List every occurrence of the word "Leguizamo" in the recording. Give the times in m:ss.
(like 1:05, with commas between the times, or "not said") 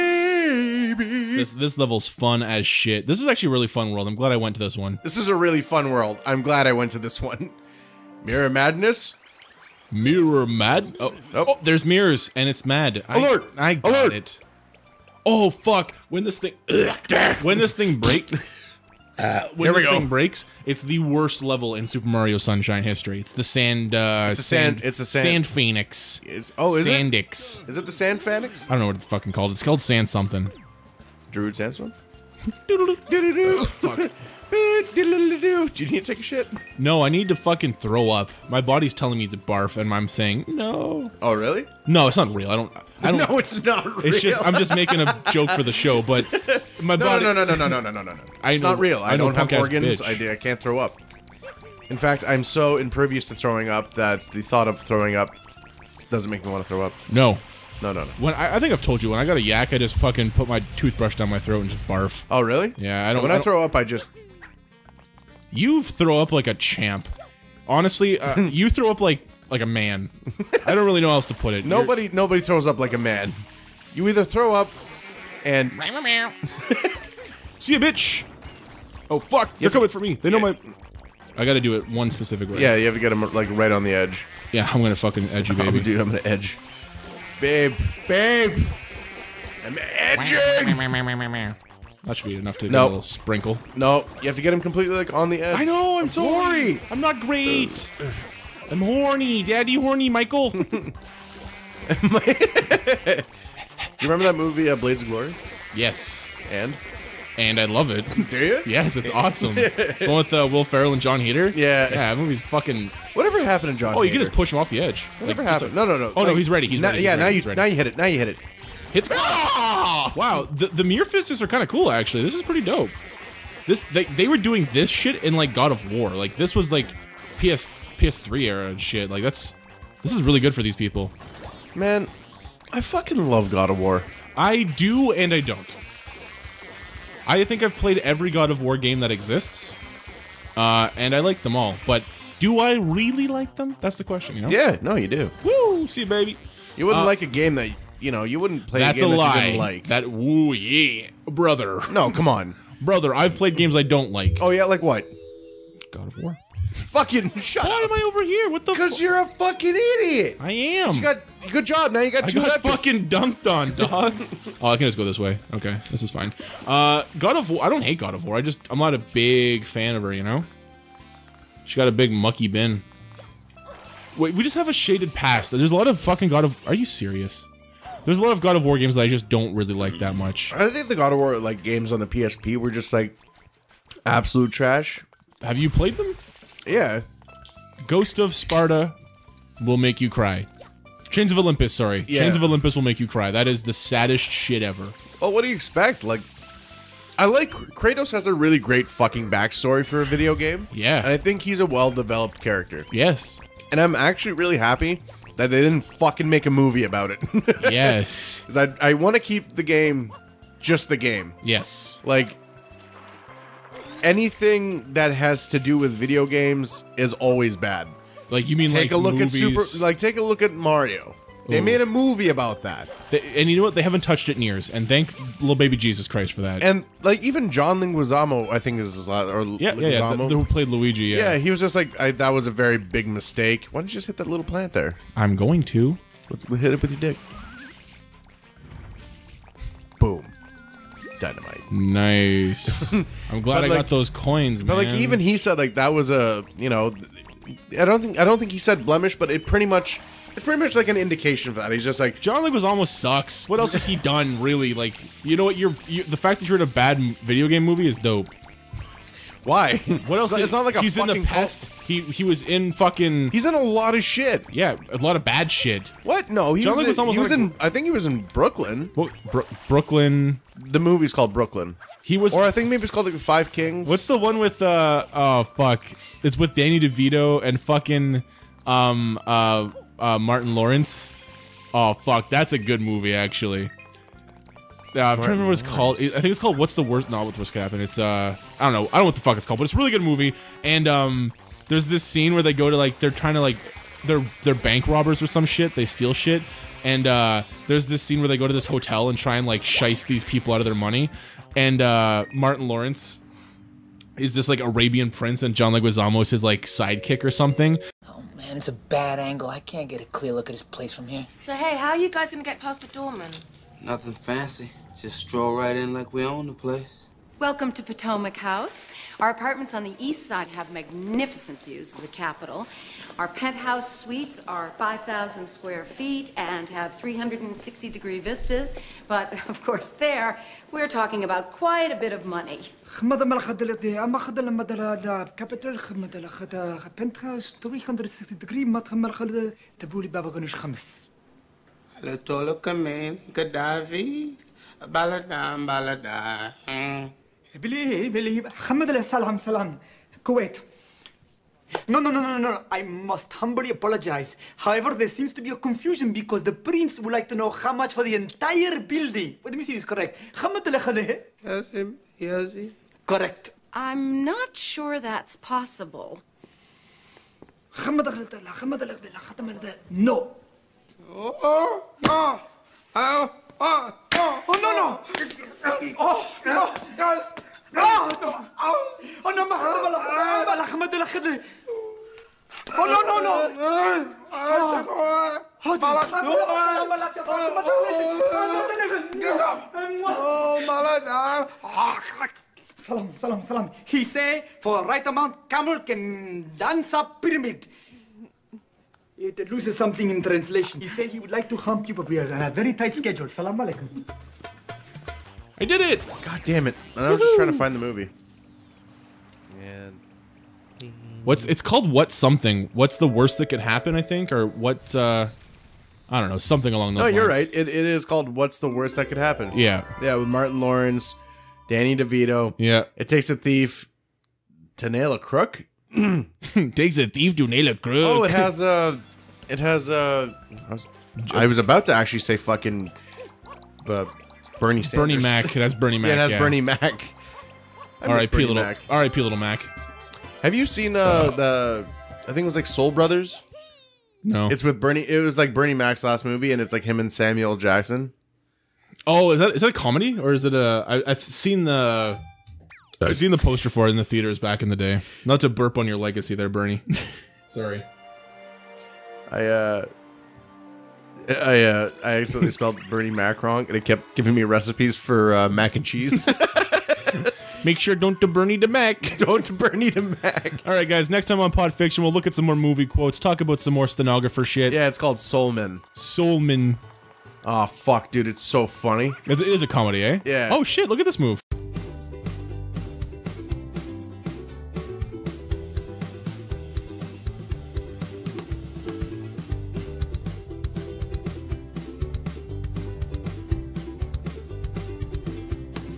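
3:47, 4:12, 5:05.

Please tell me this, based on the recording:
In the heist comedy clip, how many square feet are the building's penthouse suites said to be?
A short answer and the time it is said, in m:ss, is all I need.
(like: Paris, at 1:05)
5,000, at 5:24.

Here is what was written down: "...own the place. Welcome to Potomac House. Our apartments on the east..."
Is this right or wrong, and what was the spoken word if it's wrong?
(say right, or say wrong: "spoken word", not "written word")
right.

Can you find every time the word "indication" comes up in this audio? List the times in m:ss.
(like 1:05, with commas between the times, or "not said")
4:10.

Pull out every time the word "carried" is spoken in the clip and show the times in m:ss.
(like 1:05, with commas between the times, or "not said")
not said.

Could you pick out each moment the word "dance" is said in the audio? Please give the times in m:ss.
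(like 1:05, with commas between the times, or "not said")
6:36.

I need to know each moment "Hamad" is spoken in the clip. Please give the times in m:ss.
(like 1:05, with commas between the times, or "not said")
5:48, 6:00.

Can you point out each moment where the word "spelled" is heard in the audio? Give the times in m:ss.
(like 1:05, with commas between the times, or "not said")
7:42.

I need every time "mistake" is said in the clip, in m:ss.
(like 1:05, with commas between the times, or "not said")
3:53.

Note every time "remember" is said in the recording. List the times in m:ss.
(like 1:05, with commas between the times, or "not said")
1:44, 4:45.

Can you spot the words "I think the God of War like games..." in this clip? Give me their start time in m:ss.
3:00.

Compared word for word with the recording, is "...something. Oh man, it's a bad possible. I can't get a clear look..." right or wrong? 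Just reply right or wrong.
wrong.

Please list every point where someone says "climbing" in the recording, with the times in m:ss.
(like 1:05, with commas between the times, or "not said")
not said.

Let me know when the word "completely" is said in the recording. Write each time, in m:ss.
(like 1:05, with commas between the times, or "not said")
1:34.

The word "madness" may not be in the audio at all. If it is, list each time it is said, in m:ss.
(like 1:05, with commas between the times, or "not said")
0:08.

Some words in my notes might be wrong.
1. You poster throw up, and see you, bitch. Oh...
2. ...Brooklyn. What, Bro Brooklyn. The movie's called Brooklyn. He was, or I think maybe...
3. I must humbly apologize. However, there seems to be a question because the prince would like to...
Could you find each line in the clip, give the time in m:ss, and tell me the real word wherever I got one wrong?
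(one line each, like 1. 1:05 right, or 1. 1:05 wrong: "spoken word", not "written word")
1. 1:13 wrong: "either", not "poster"
2. 4:28 right
3. 5:52 wrong: "confusion", not "question".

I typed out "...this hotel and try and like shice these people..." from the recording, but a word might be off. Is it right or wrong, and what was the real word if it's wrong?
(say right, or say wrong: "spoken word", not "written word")
right.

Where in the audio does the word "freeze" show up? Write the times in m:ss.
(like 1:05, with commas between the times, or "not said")
not said.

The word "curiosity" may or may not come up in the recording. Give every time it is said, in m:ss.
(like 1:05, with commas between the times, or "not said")
not said.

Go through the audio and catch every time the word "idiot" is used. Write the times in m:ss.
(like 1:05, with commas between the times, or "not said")
2:39.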